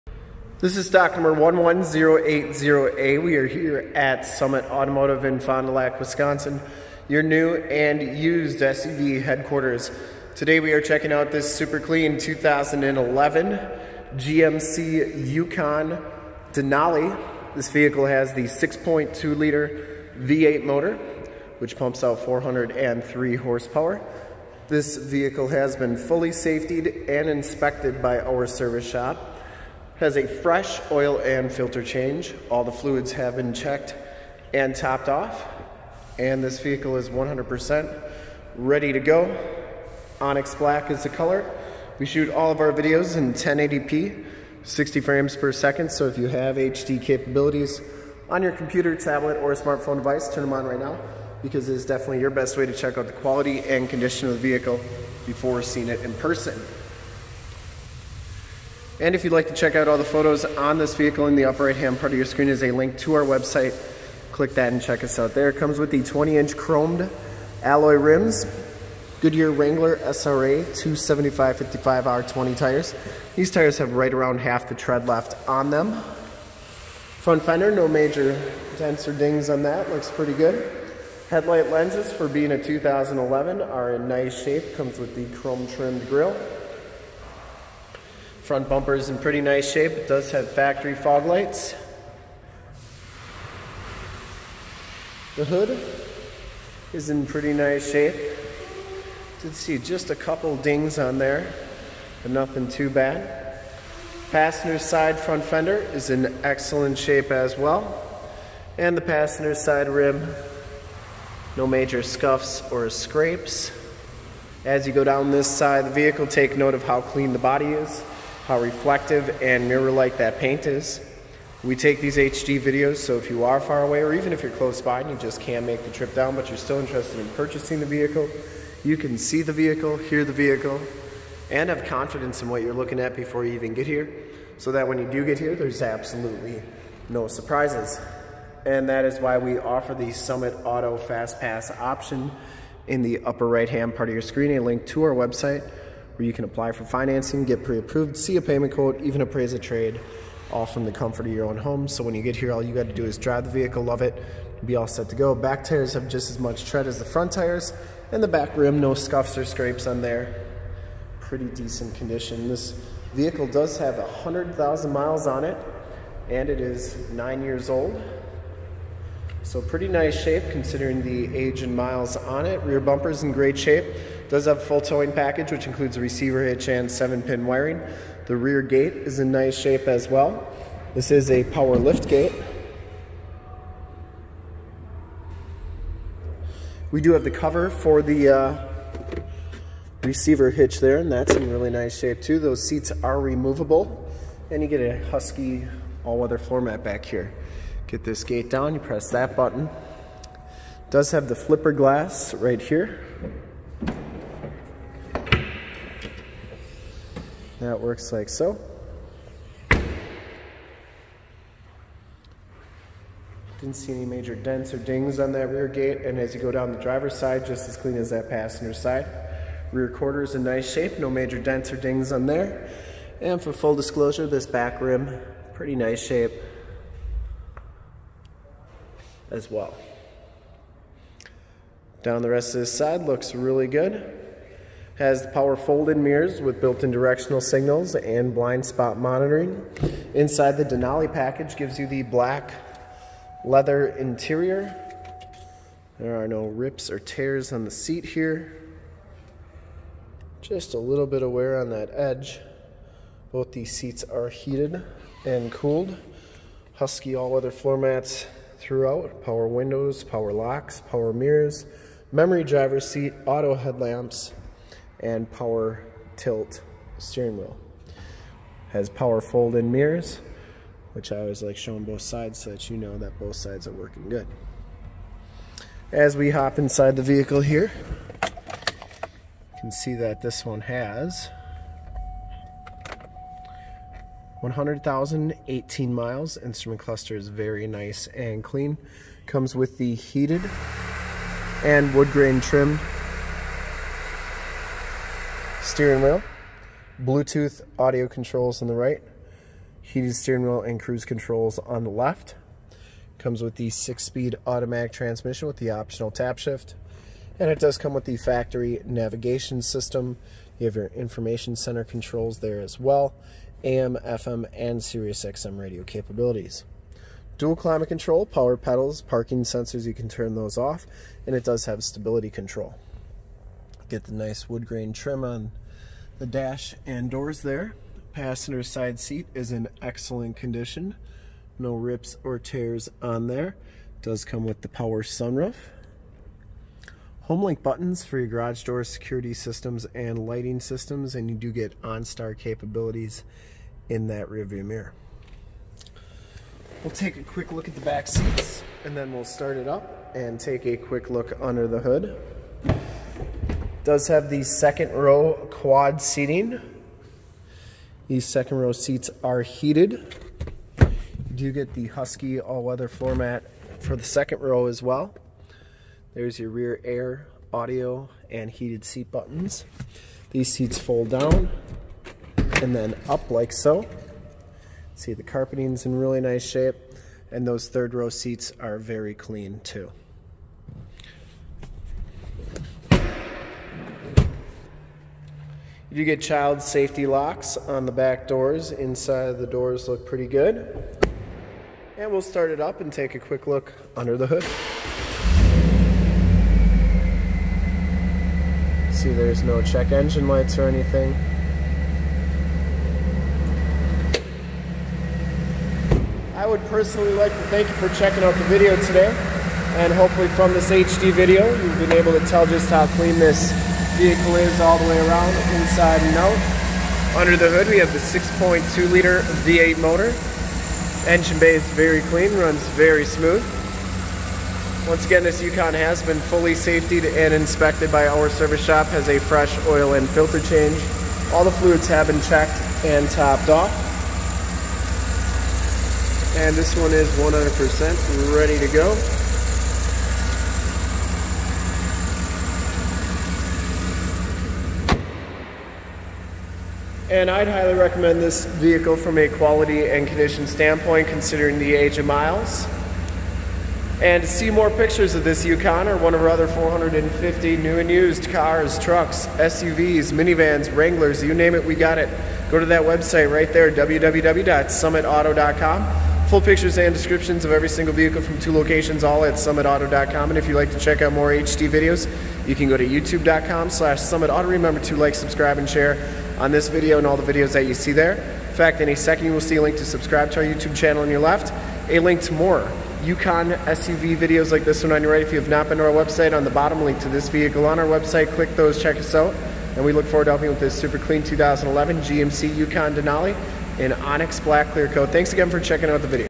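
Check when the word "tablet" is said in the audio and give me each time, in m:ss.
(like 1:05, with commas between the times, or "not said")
0:48.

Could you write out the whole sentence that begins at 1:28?
Front bumper is in pretty nice shape.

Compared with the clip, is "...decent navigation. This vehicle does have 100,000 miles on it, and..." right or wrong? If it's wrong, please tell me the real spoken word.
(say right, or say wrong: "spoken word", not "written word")
wrong: "condition", not "navigation".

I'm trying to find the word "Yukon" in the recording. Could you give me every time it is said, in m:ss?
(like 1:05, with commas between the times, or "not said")
0:15, 7:05, 7:35, 8:03, 8:12.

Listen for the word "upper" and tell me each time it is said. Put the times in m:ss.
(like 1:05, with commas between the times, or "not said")
1:01, 2:23.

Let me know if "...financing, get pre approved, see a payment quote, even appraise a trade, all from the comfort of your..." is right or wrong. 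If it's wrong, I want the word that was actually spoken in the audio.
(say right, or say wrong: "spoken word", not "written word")
right.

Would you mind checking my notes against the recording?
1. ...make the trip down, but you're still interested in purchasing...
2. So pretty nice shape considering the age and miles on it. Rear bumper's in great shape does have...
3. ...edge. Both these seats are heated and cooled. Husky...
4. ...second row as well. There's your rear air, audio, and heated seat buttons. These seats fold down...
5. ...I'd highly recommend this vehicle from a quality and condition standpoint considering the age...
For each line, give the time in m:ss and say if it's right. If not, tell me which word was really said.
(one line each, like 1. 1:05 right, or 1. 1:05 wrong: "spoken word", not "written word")
1. 2:05 right
2. 2:49 right
3. 4:11 right
4. 6:04 right
5. 7:27 right.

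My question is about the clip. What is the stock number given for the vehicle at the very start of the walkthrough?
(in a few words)
11080A.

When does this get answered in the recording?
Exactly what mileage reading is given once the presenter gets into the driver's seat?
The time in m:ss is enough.
4:44.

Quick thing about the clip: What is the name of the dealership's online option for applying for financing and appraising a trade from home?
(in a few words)
Summit Auto Fast Pass.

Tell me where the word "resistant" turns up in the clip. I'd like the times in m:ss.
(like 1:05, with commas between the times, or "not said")
not said.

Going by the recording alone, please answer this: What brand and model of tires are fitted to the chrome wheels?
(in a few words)
Goodyear Wrangler SRA.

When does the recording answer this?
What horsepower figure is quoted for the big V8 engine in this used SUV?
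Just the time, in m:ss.
0:22.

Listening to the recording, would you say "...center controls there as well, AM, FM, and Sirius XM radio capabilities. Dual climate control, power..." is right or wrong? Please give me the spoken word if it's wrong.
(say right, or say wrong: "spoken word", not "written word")
right.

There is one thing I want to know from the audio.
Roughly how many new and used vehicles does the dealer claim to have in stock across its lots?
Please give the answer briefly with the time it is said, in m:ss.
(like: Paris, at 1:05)
450, at 7:36.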